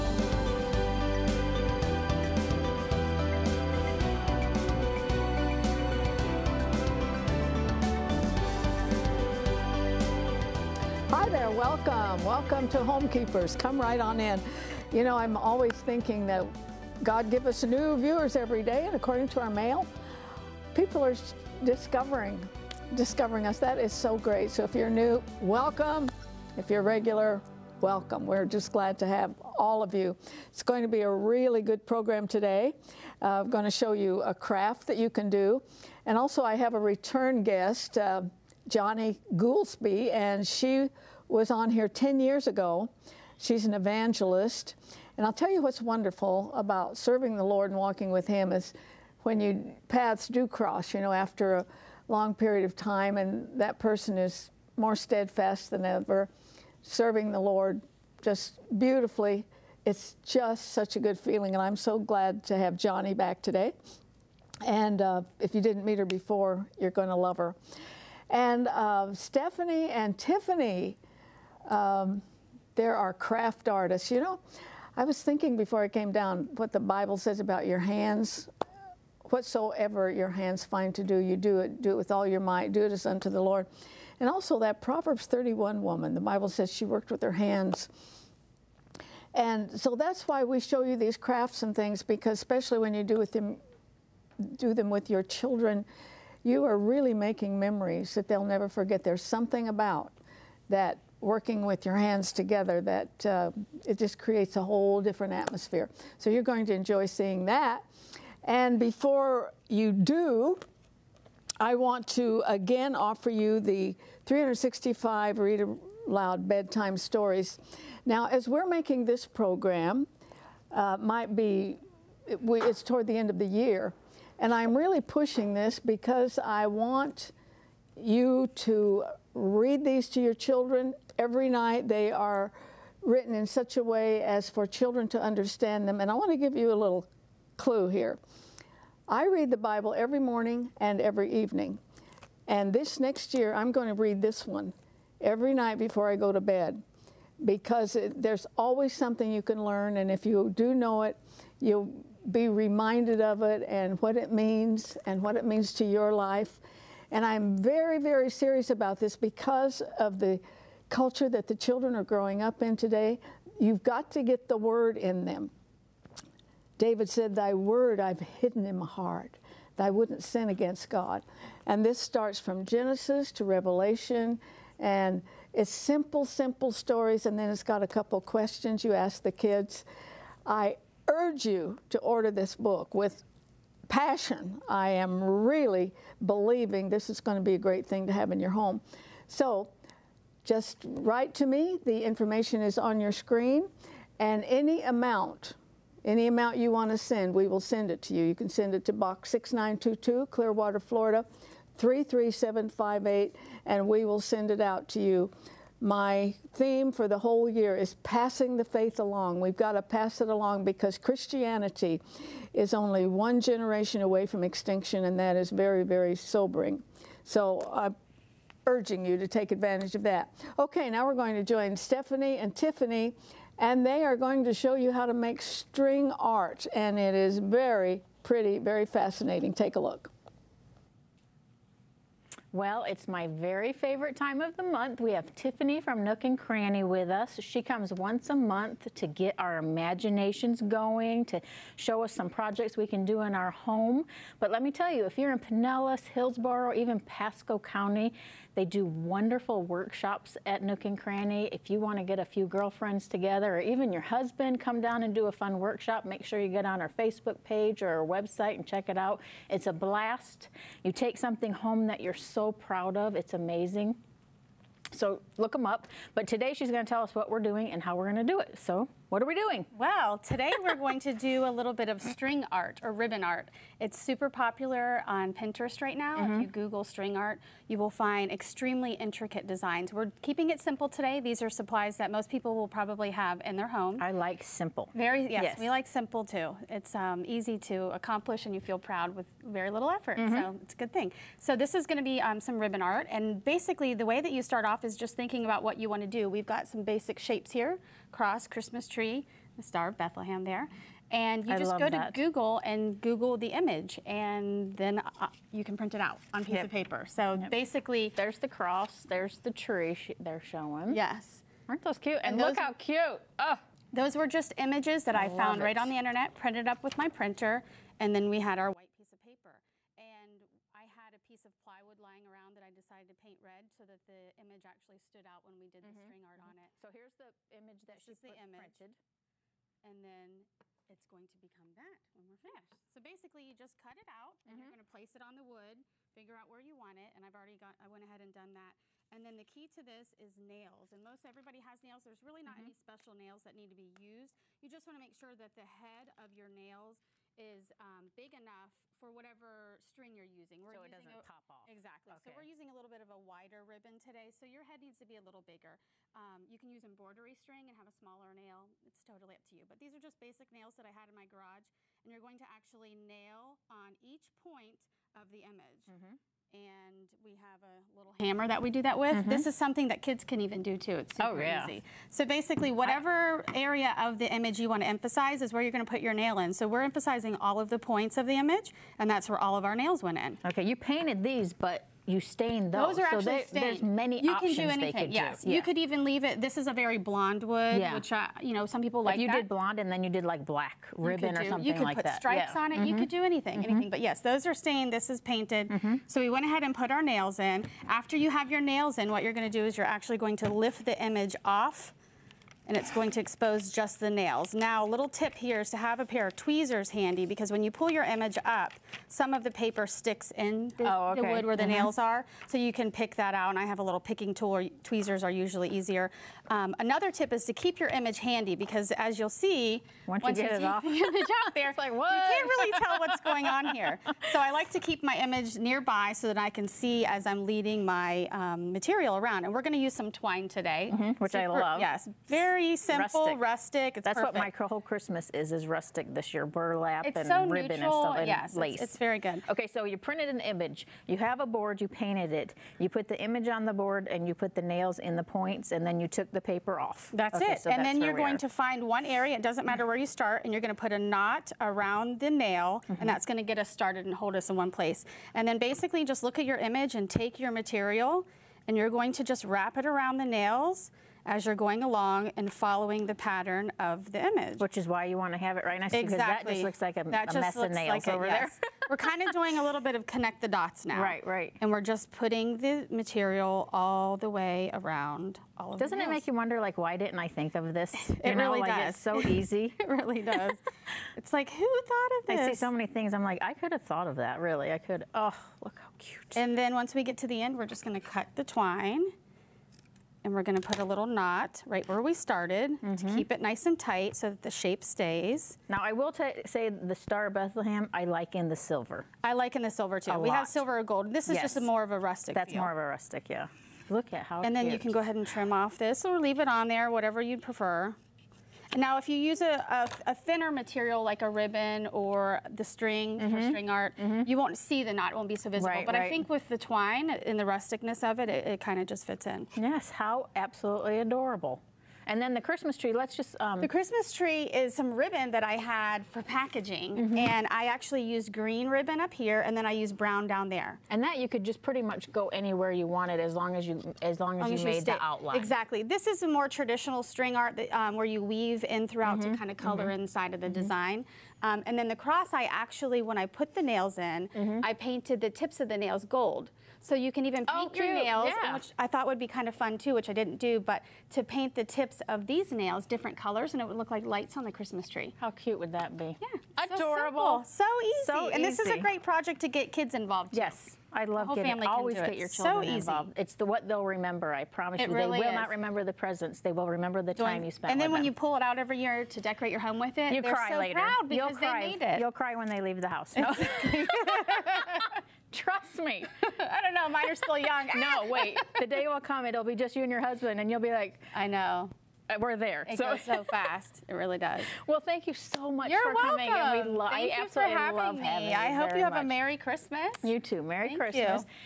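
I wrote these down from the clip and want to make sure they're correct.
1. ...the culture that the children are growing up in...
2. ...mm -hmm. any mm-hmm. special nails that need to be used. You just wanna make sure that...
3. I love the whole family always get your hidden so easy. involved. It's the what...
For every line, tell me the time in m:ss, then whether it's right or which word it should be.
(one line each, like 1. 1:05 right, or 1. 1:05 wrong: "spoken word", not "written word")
1. 2:40 right
2. 5:42 right
3. 9:20 wrong: "children", not "hidden".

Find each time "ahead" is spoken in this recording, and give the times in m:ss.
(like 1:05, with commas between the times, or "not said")
5:38, 6:36, 8:24.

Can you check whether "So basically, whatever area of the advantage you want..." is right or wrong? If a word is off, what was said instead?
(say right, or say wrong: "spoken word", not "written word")
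wrong: "image", not "advantage".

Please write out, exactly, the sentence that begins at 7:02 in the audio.
You can't really tell what's going on here.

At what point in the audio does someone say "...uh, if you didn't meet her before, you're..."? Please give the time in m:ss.
1:05.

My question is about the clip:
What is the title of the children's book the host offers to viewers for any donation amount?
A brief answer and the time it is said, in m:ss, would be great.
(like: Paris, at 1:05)
365 Read Aloud Bedtime Stories, at 1:54.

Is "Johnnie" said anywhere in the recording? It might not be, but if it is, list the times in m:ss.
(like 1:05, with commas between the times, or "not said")
0:38, 1:02.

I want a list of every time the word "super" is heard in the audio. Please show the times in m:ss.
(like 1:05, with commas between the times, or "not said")
4:33, 6:11, 7:11.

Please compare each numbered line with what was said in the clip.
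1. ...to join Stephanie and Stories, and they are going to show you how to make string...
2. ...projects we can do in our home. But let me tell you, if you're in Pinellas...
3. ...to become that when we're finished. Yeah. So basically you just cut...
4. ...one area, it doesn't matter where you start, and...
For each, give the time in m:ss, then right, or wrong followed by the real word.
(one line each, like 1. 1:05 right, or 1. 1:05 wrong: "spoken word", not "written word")
1. 3:41 wrong: "Tiffany", not "Stories"
2. 4:02 right
3. 5:31 right
4. 7:28 right.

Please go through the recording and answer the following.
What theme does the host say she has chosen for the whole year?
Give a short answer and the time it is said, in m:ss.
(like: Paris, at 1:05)
Passing the faith along, at 3:28.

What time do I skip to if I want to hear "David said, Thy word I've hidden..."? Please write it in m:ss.
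2:46.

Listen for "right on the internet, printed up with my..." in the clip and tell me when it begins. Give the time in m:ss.
5:15.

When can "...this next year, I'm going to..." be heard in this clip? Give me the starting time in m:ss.
2:22.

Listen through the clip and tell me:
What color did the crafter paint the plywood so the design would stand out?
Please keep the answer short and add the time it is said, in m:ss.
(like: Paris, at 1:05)
Red, at 5:23.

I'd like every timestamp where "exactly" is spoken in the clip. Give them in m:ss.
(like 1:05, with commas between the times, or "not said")
5:51, 7:45, 8:55.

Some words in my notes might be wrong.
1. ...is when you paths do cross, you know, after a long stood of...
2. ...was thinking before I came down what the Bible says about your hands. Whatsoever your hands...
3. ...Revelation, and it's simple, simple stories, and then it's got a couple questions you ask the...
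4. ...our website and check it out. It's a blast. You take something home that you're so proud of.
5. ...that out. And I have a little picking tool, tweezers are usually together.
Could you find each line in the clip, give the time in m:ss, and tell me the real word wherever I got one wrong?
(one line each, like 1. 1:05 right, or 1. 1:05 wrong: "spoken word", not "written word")
1. 0:48 wrong: "period", not "stood"
2. 1:15 right
3. 2:53 right
4. 4:17 right
5. 6:53 wrong: "easier", not "together".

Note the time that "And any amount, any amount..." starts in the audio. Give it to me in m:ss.
3:14.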